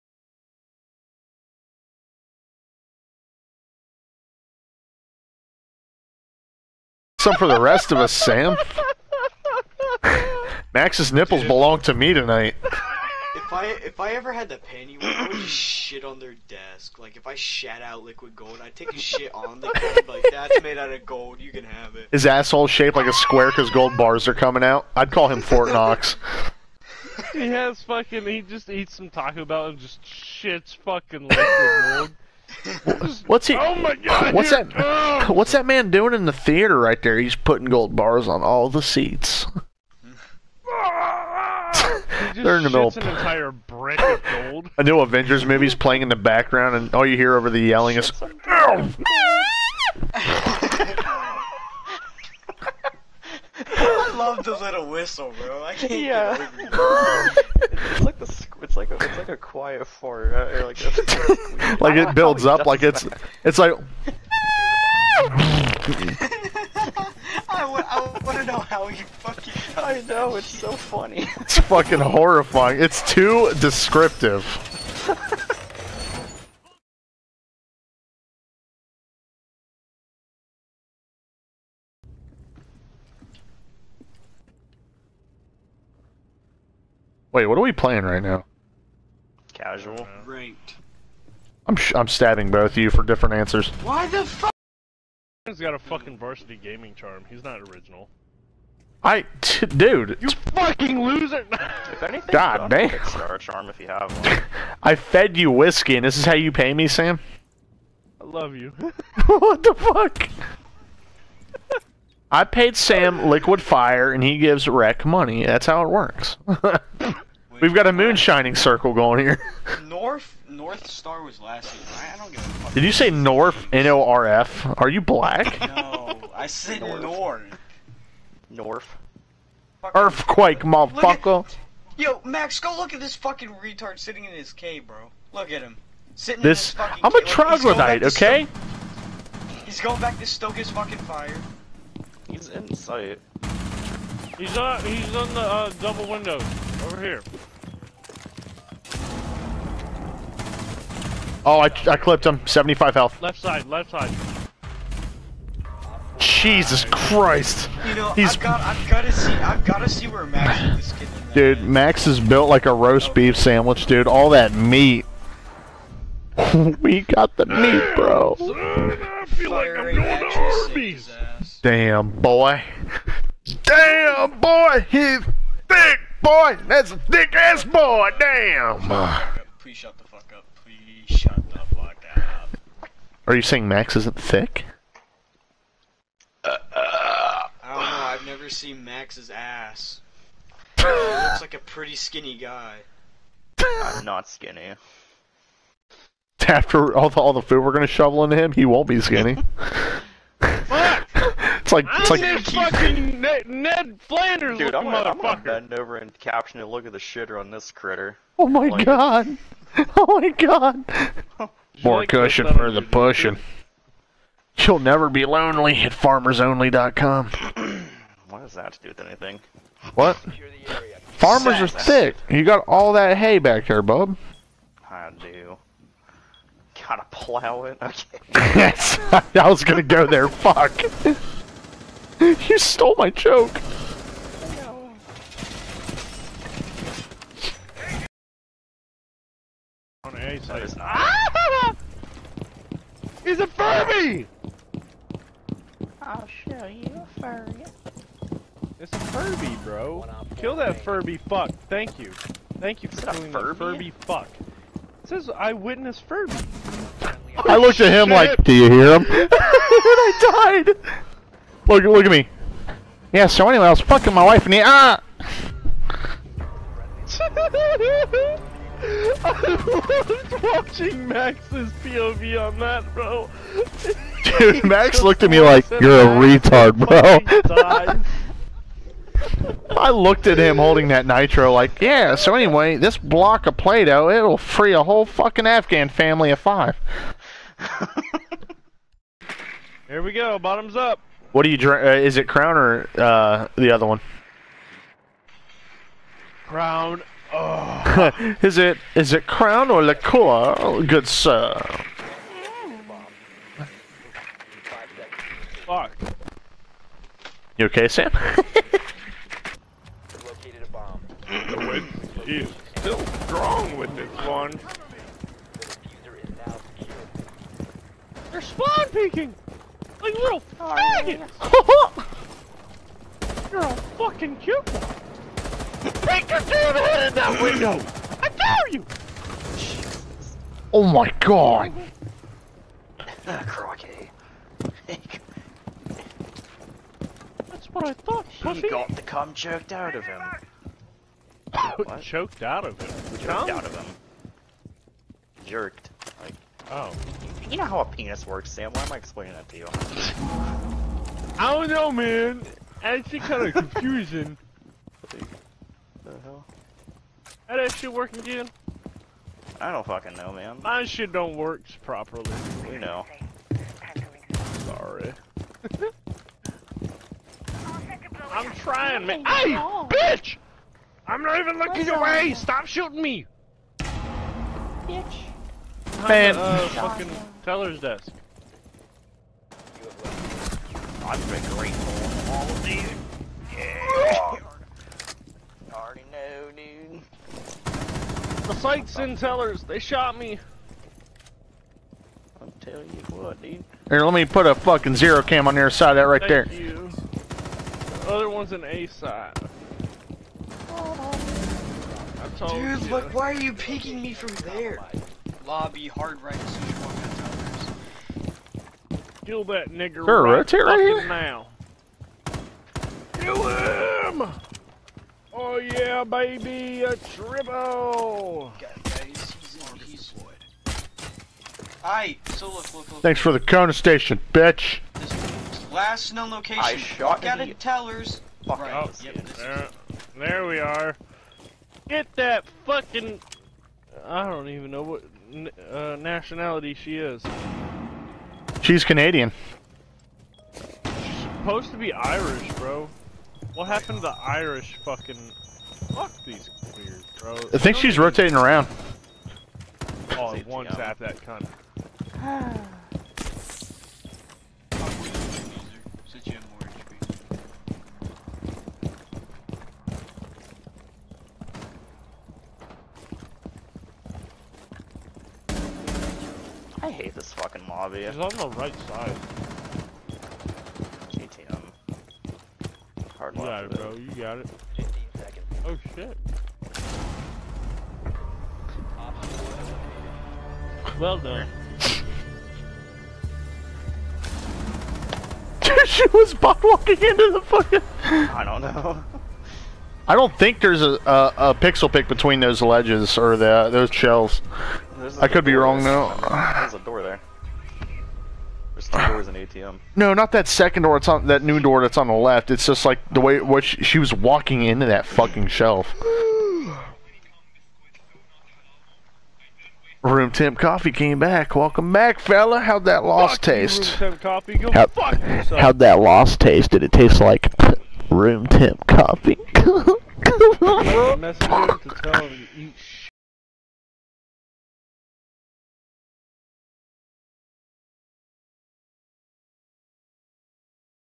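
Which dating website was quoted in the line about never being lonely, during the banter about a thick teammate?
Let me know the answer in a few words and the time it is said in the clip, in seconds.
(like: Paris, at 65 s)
farmersonly.com, at 215 s.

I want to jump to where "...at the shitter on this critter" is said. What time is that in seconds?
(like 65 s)
206 s.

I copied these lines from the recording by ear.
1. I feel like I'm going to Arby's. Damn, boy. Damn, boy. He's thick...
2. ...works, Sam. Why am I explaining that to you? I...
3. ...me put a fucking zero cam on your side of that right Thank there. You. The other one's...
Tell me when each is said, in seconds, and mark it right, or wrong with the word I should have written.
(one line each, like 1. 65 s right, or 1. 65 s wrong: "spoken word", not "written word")
1. 168 s right
2. 348 s right
3. 394 s right.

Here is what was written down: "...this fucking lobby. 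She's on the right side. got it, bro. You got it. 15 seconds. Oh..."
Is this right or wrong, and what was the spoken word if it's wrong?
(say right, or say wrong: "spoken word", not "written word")
right.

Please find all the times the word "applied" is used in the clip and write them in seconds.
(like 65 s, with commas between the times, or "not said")
not said.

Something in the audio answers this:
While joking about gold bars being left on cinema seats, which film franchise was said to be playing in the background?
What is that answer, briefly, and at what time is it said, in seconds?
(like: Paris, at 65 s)
Avengers, at 44 s.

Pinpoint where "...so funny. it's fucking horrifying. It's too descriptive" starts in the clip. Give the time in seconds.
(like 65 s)
70 s.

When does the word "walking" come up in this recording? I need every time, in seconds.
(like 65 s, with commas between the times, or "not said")
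486 s, 504 s.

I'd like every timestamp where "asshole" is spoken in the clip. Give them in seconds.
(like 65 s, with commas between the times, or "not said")
22 s.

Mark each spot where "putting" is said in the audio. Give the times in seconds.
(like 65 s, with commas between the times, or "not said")
37 s.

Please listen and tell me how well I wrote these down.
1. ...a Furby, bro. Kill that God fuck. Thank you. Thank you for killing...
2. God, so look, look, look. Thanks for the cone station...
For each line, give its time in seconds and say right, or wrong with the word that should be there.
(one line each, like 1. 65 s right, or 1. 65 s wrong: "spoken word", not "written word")
1. 248 s wrong: "Furby", not "God"
2. 418 s right.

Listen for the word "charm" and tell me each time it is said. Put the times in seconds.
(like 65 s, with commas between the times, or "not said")
96 s, 103 s.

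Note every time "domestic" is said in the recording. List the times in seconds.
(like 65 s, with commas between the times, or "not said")
not said.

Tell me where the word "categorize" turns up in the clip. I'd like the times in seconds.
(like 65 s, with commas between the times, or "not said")
not said.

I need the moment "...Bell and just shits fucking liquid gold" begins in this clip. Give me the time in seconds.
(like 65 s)
29 s.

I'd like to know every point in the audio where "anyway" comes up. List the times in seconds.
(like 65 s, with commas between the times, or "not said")
263 s, 282 s.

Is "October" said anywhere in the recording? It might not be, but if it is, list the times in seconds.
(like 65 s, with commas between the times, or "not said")
not said.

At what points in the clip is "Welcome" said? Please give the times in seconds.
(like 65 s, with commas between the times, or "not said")
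511 s.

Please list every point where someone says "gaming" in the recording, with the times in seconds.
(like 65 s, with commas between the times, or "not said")
96 s.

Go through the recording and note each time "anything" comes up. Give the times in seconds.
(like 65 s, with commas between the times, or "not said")
102 s, 219 s.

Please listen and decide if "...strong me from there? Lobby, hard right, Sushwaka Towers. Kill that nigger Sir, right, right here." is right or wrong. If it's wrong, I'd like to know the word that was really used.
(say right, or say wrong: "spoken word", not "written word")
wrong: "peeking", not "strong".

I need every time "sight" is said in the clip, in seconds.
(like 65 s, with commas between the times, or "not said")
142 s, 388 s.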